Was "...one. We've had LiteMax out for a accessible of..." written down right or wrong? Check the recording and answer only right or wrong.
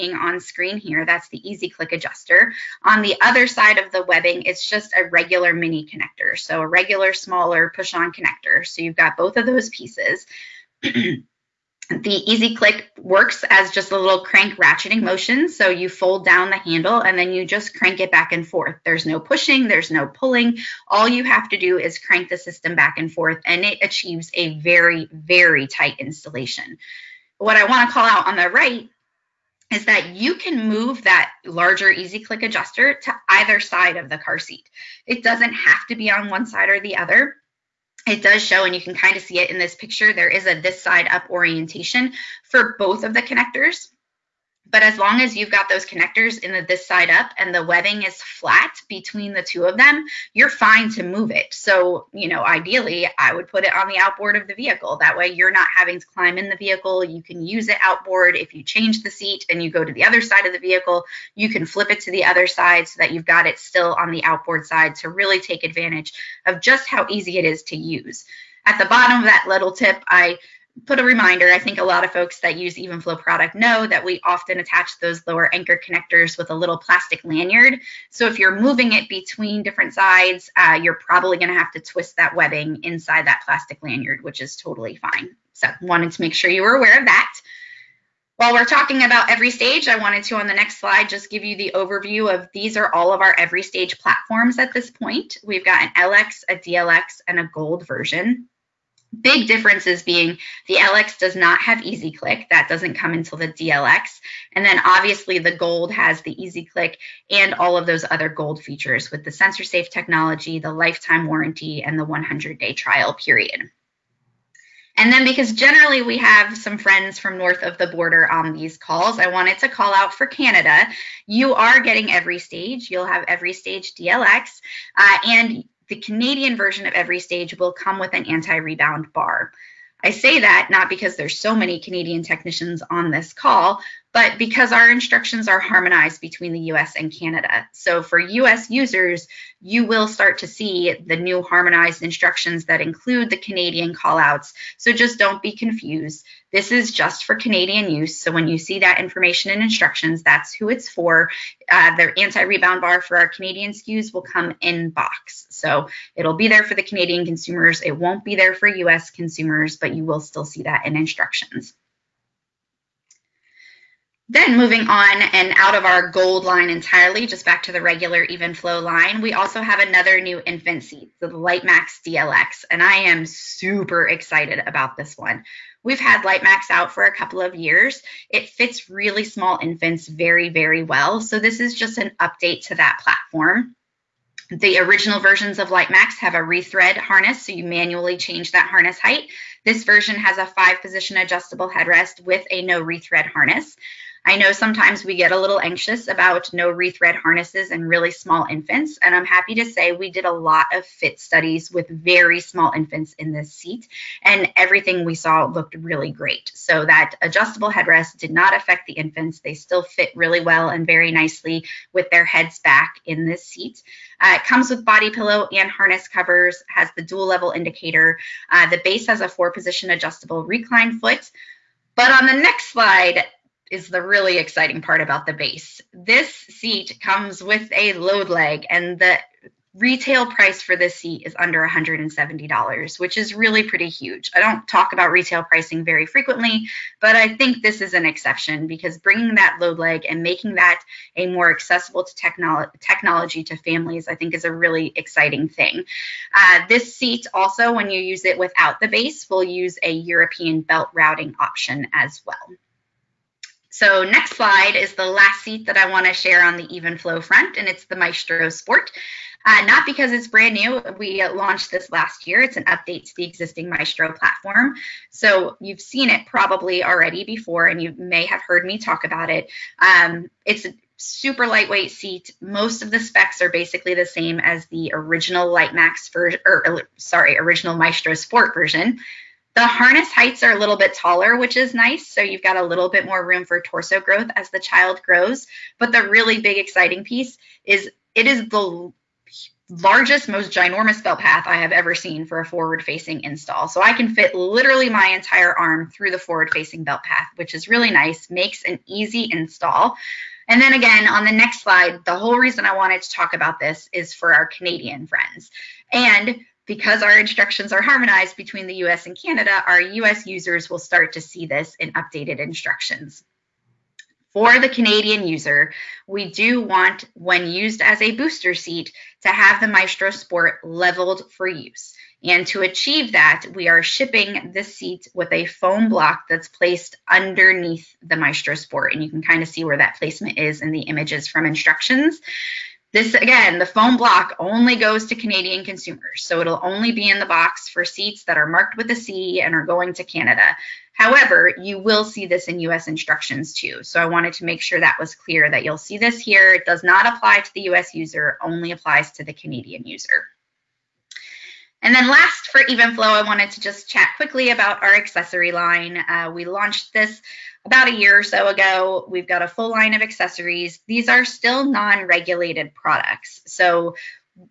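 wrong.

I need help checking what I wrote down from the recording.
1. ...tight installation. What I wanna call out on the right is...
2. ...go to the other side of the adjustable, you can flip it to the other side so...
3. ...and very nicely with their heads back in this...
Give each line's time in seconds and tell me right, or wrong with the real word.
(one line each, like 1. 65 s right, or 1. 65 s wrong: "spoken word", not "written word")
1. 25 s right
2. 59 s wrong: "vehicle", not "adjustable"
3. 210 s right.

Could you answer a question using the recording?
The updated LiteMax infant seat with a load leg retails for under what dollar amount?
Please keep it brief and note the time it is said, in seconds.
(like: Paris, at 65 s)
$170, at 231 s.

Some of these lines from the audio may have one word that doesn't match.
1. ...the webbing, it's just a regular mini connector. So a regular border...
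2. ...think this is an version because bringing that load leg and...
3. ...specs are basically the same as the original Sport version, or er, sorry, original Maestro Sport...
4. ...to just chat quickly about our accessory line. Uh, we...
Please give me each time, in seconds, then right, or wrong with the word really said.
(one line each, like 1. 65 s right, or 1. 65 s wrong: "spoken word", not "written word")
1. 3 s wrong: "smaller", not "border"
2. 237 s wrong: "exception", not "version"
3. 272 s wrong: "LiteMax", not "Sport"
4. 353 s right.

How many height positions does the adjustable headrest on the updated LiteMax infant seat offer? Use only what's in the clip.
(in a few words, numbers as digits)
5.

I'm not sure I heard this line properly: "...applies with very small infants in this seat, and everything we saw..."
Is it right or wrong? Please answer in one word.
wrong.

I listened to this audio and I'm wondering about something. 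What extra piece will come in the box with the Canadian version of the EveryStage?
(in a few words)
anti-rebound bar.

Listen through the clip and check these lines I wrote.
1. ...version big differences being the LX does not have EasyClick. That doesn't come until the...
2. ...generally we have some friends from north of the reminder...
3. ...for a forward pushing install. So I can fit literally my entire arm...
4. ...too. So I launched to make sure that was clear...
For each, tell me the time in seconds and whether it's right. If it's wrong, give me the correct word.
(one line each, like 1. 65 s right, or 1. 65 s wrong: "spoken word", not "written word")
1. 97 s right
2. 115 s wrong: "border", not "reminder"
3. 292 s wrong: "facing", not "pushing"
4. 343 s wrong: "wanted", not "launched".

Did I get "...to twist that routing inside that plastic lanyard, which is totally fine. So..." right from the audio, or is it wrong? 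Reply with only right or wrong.
wrong.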